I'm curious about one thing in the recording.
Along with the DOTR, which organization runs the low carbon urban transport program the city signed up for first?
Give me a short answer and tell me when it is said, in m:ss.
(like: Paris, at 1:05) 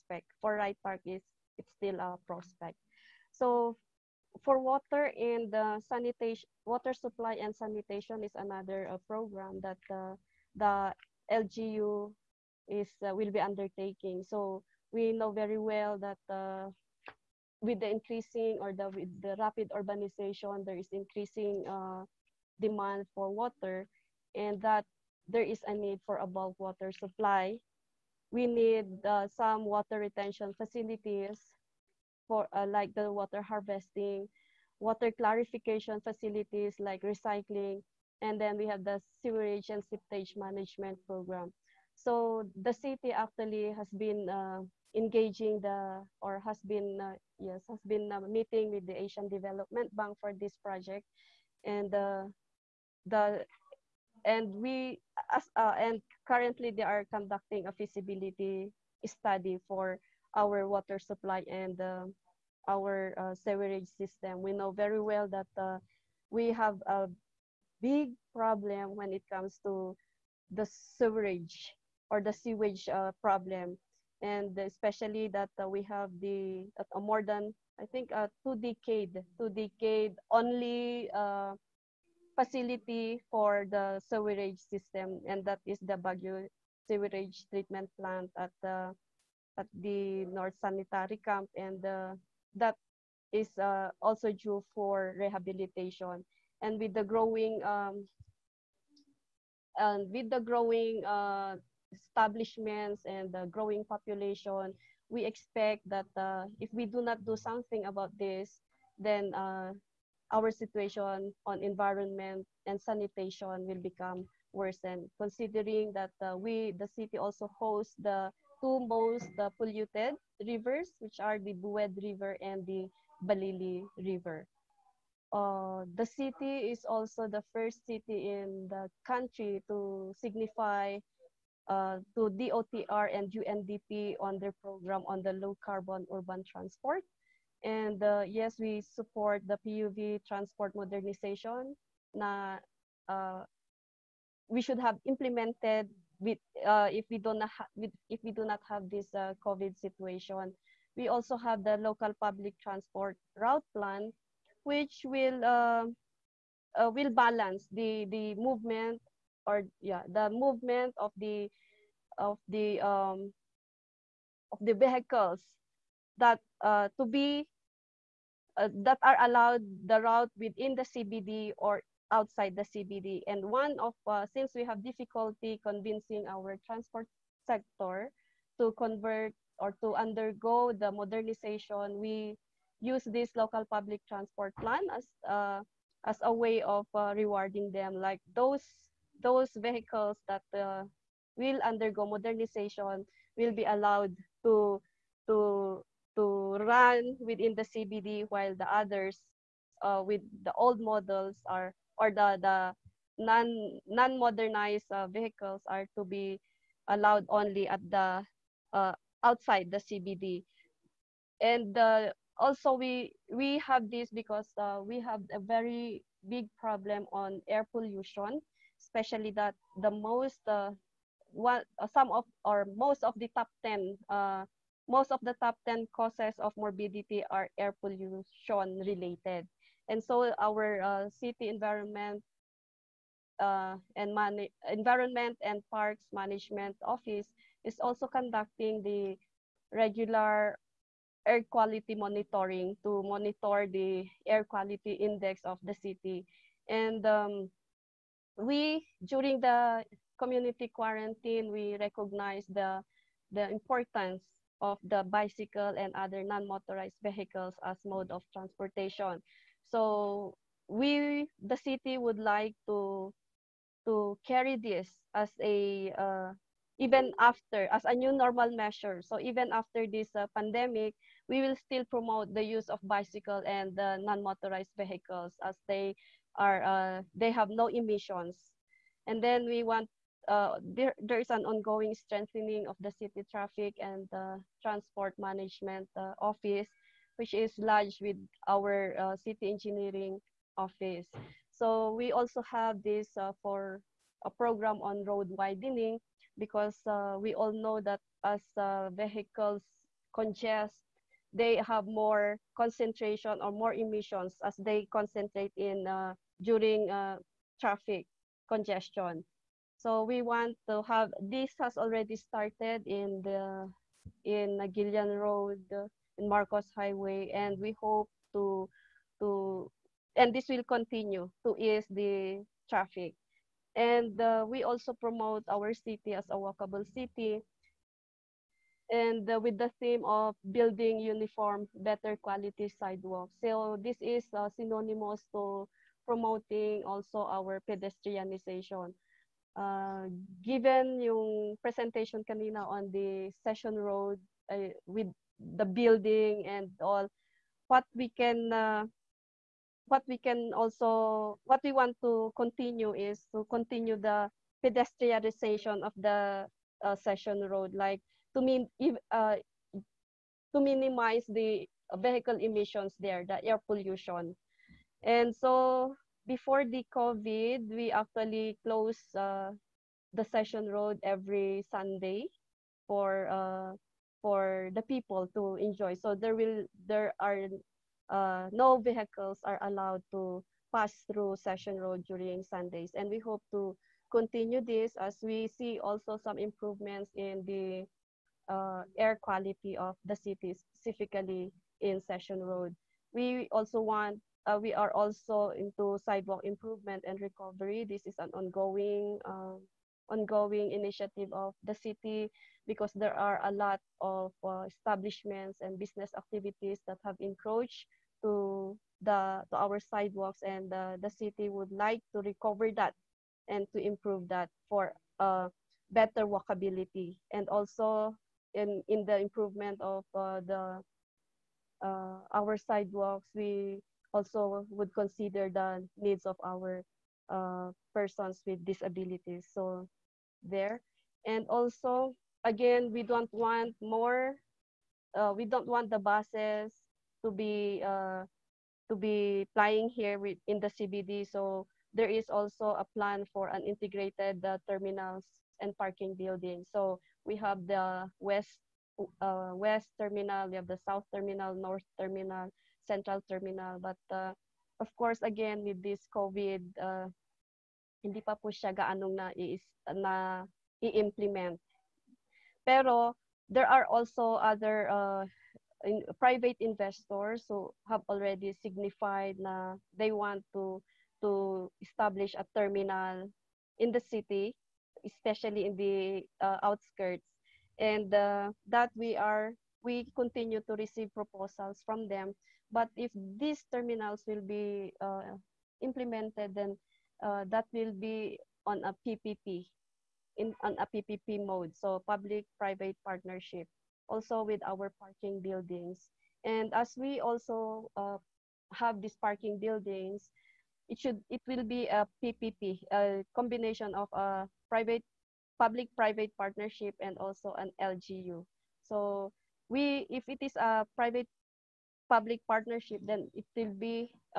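UNDP, at 2:13.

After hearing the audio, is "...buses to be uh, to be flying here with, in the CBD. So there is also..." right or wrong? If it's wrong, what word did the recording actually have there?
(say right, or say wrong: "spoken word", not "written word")
right.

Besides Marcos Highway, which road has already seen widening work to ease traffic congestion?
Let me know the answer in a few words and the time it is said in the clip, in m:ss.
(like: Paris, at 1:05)
Naguilian Road, at 5:14.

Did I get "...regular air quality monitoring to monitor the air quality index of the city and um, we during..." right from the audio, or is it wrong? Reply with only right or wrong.
right.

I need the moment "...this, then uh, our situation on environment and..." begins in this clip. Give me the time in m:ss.
1:48.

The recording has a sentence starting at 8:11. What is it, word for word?
So public-private partnership, also with our parking buildings.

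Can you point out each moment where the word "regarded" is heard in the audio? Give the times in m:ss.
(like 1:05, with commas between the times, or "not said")
not said.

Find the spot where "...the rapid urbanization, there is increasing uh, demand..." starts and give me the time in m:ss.
0:19.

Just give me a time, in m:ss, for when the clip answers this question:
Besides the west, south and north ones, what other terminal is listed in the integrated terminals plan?
7:32.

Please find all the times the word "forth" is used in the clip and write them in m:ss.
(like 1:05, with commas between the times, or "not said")
not said.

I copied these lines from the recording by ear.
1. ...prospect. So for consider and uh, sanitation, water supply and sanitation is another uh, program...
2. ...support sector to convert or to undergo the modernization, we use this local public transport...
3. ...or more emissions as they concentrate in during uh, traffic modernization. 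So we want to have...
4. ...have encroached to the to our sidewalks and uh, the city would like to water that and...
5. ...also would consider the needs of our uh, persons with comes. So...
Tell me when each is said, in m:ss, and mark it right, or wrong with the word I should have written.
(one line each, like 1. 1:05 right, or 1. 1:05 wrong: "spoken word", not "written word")
1. 0:02 wrong: "water", not "consider"
2. 2:56 wrong: "transport", not "support"
3. 5:03 wrong: "congestion", not "modernization"
4. 6:47 wrong: "recover", not "water"
5. 7:04 wrong: "disabilities", not "comes".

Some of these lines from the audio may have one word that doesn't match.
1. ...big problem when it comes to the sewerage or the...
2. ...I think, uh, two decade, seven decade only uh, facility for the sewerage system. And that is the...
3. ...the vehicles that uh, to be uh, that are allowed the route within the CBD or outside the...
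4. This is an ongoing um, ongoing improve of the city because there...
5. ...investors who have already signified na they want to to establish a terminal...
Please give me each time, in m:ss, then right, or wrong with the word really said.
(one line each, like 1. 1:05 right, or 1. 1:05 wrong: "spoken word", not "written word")
1. 1:07 right
2. 1:17 wrong: "two", not "seven"
3. 2:44 right
4. 6:37 wrong: "initiative", not "improve"
5. 7:46 right.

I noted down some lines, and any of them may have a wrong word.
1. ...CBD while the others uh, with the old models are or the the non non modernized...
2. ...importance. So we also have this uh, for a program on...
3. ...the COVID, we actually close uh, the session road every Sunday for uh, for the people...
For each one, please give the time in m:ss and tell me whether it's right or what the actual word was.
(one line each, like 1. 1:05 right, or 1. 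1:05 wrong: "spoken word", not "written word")
1. 3:17 right
2. 4:50 wrong: "office", not "importance"
3. 6:06 right.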